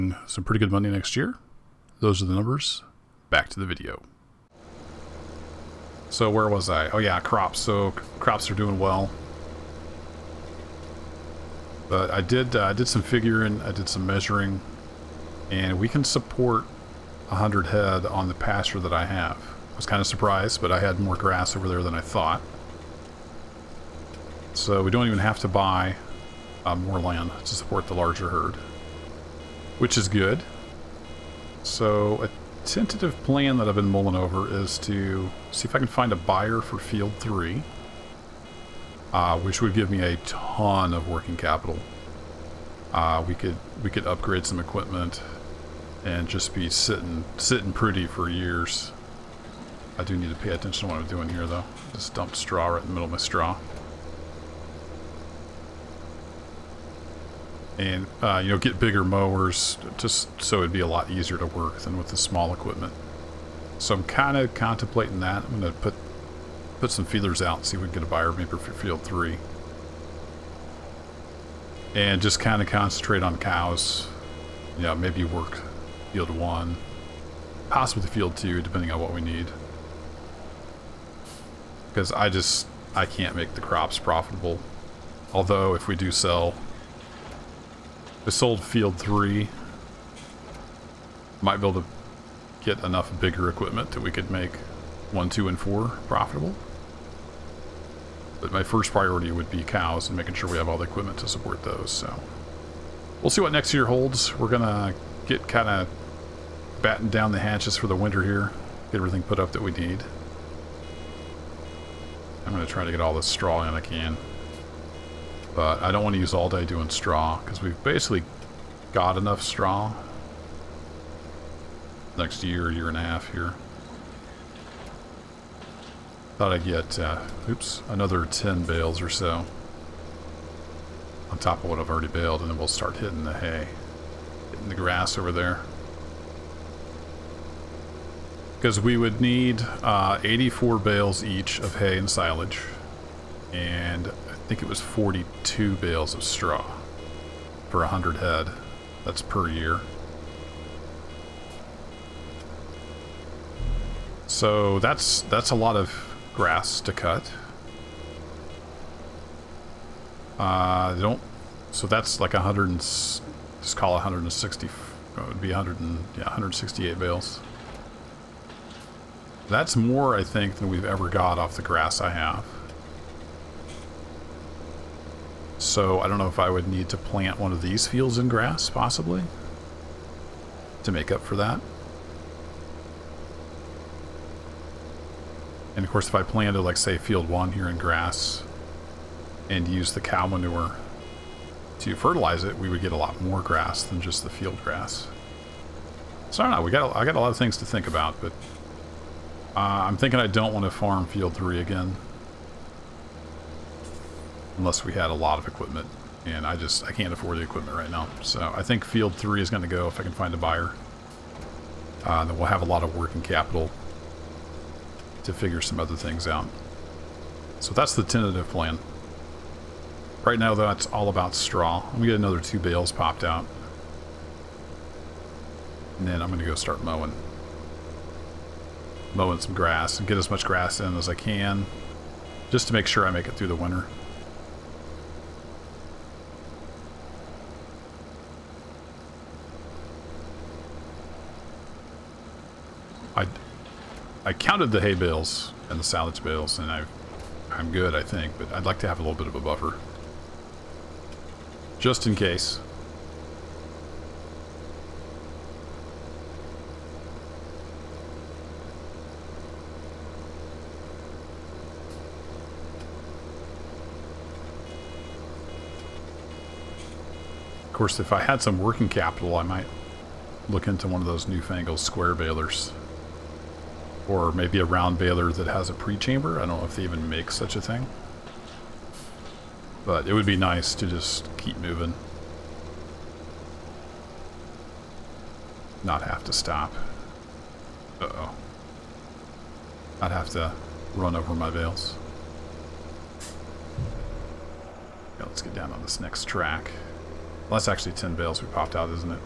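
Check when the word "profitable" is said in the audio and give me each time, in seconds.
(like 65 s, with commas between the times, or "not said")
83 s, 96 s.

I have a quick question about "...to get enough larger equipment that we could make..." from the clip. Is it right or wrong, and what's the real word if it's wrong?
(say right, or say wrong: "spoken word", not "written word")
wrong: "bigger", not "larger".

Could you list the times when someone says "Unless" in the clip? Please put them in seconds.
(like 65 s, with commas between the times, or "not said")
204 s.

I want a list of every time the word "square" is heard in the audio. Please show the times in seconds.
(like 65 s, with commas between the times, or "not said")
271 s.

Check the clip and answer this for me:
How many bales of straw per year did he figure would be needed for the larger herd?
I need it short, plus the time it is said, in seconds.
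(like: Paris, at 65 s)
42, at 144 s.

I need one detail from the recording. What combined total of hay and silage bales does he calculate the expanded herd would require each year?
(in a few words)
168.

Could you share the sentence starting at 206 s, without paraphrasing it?
And I just, I can't afford the equipment right now.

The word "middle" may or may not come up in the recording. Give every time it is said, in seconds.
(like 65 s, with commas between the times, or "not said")
52 s.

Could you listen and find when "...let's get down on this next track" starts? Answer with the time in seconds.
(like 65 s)
295 s.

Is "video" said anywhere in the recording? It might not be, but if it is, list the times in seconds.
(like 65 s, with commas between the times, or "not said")
3 s.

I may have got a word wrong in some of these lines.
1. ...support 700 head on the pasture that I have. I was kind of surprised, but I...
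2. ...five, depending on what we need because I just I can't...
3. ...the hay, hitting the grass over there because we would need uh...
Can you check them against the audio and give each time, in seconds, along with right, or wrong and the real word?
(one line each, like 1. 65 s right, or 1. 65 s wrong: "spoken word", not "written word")
1. 16 s wrong: "100", not "700"
2. 78 s wrong: "two", not "five"
3. 133 s right.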